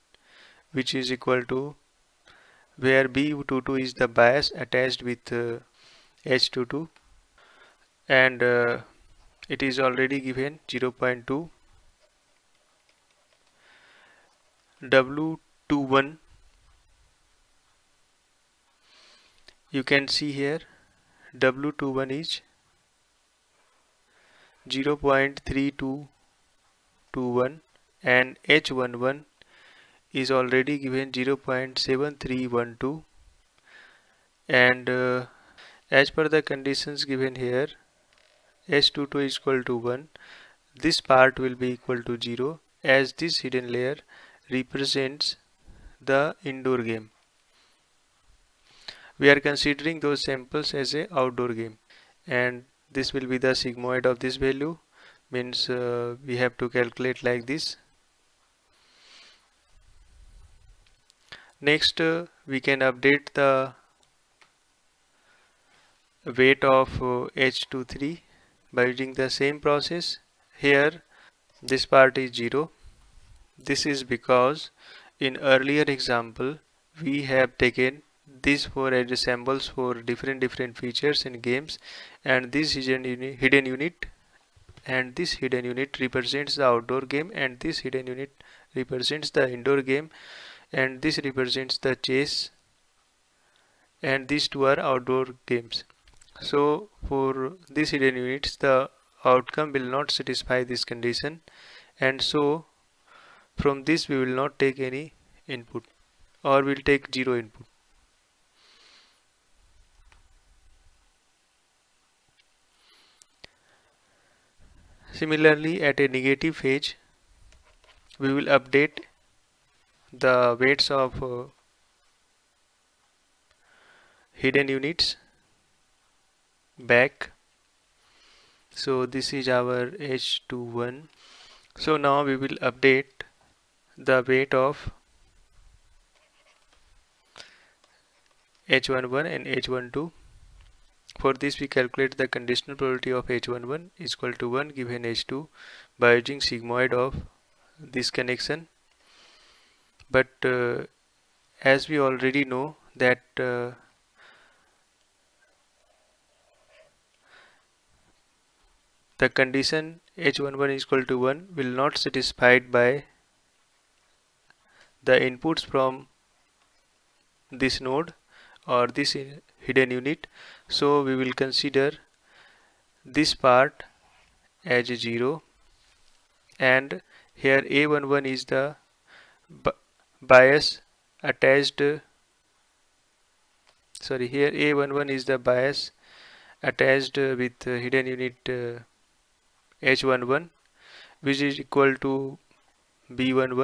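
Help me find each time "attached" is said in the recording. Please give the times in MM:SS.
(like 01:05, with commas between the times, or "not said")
00:04, 03:01, 03:06.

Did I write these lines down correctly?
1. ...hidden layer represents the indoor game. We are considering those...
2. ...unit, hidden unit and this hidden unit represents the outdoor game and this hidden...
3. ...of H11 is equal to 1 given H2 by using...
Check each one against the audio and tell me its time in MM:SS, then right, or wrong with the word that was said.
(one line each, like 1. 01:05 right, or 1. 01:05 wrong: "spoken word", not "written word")
1. 00:43 right
2. 01:23 right
3. 02:23 right.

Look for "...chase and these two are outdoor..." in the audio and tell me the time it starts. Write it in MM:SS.
01:31.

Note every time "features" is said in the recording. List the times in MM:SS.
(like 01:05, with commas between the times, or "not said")
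01:20.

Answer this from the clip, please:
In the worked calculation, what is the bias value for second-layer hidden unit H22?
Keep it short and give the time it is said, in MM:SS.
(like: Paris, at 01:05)
0.2, at 00:10.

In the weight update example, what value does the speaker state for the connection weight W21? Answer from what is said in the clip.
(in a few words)
0.3221.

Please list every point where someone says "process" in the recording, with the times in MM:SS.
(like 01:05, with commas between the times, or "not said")
01:09.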